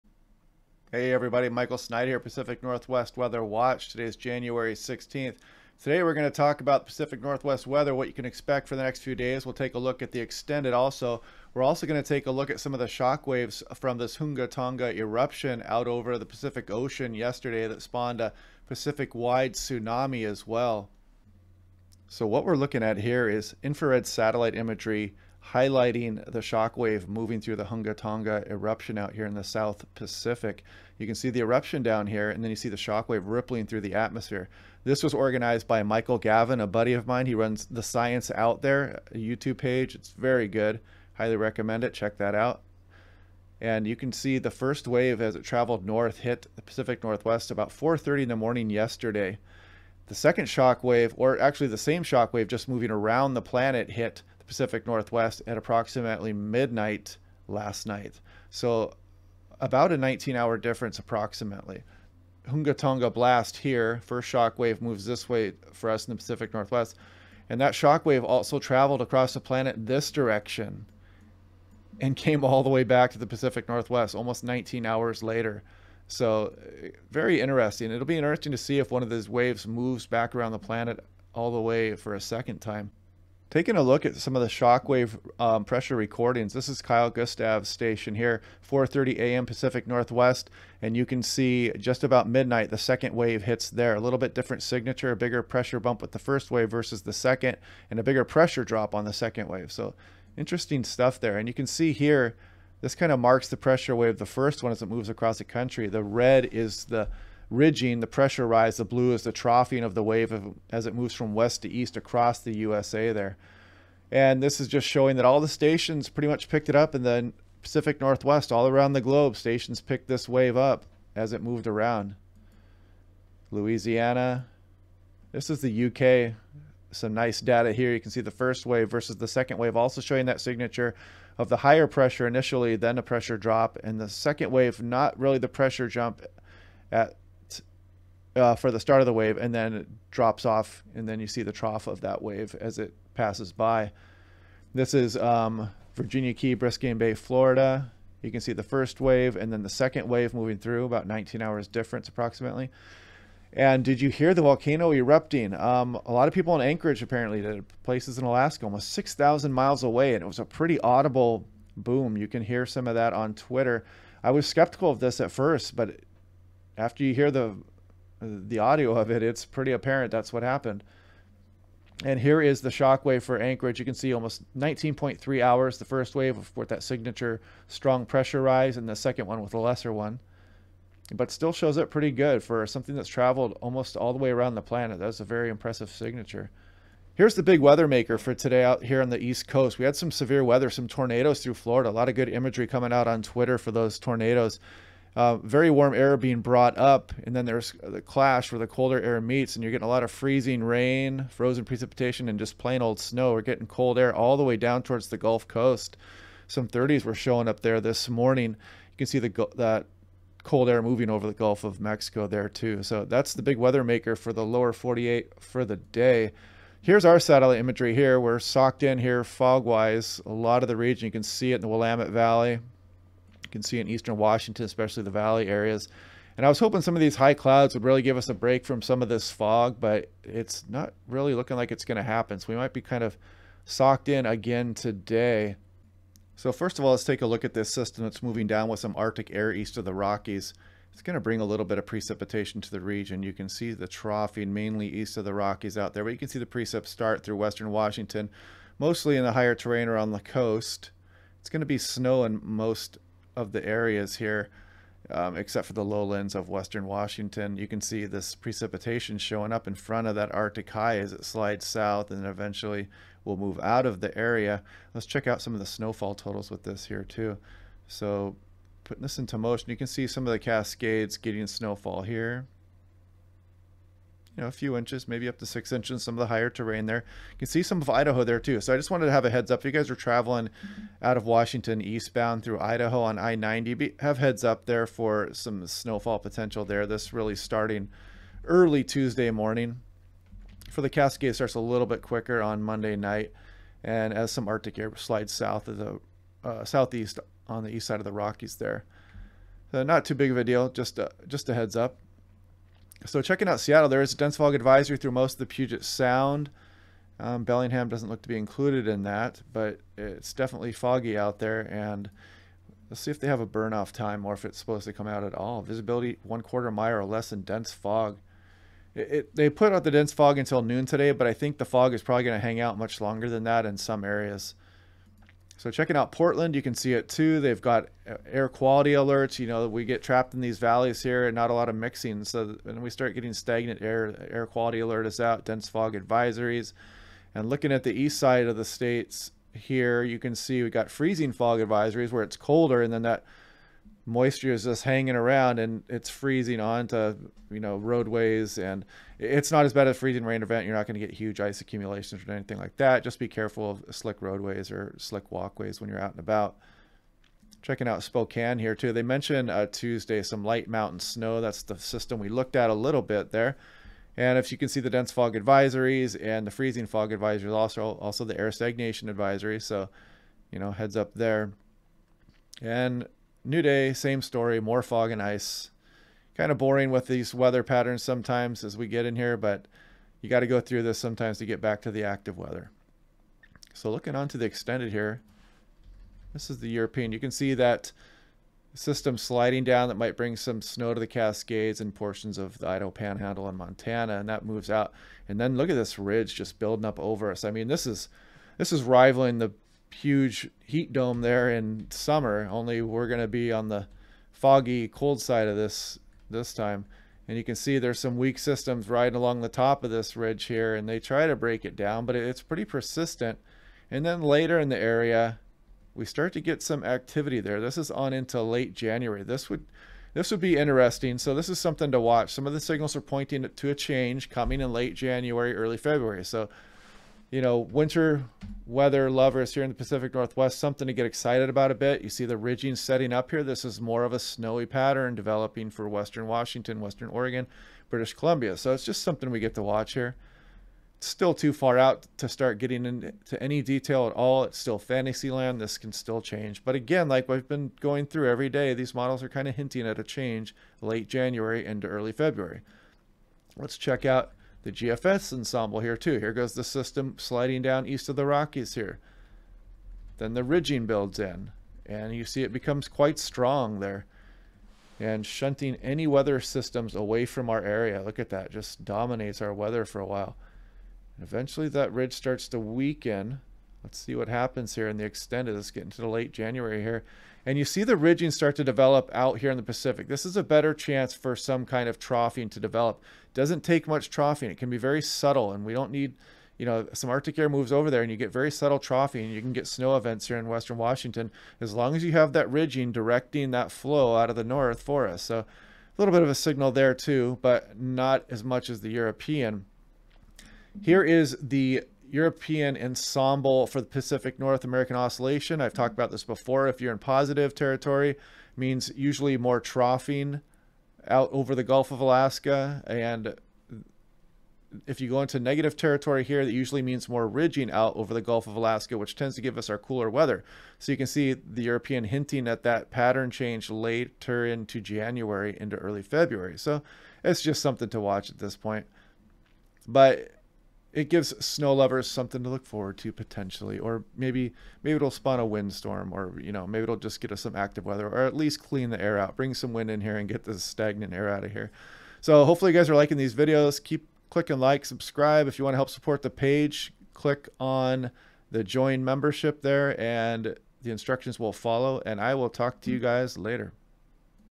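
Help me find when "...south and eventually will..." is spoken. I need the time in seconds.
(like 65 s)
261 s.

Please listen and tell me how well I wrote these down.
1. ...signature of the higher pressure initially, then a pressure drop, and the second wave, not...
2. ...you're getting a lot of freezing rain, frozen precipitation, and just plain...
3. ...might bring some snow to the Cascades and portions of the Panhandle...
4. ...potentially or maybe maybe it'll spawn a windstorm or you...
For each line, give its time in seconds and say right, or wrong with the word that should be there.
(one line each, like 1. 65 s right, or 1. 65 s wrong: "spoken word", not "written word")
1. 130 s right
2. 199 s right
3. 389 s wrong: "Idaho", not "Panhandle"
4. 533 s right.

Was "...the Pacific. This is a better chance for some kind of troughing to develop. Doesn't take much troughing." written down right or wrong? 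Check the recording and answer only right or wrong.
right.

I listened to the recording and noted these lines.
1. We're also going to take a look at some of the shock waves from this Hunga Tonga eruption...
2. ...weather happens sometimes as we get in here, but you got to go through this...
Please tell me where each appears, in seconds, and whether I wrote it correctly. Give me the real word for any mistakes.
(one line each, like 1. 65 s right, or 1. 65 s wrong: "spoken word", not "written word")
1. 11 s right
2. 377 s wrong: "patterns", not "happens".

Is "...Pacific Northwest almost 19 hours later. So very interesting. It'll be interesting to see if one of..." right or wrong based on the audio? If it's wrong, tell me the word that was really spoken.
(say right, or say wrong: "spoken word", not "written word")
right.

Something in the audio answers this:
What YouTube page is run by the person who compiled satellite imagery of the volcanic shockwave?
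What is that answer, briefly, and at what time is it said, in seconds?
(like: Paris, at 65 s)
The Science Out There, at 37 s.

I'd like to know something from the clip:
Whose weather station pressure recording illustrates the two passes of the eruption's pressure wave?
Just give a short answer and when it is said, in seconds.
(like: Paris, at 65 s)
Kyle Gustav, at 86 s.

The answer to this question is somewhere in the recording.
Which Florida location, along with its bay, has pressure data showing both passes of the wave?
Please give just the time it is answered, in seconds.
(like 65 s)
145 s.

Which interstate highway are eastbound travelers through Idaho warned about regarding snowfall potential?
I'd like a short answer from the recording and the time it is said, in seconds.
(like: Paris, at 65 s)
I-90, at 283 s.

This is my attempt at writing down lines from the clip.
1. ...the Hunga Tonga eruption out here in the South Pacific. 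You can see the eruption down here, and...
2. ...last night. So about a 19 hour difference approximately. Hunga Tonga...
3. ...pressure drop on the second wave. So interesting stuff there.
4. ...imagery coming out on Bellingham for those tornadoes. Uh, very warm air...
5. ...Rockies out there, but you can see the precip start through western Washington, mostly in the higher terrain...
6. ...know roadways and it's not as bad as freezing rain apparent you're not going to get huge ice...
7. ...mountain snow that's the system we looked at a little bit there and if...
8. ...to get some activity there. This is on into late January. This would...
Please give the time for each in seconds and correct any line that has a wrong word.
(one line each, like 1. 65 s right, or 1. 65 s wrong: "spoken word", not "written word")
1. 27 s right
2. 57 s right
3. 98 s right
4. 192 s wrong: "Twitter", not "Bellingham"
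5. 245 s right
6. 347 s wrong: "event", not "apparent"
7. 360 s right
8. 416 s right.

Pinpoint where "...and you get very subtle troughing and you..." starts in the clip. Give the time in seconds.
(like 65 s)
488 s.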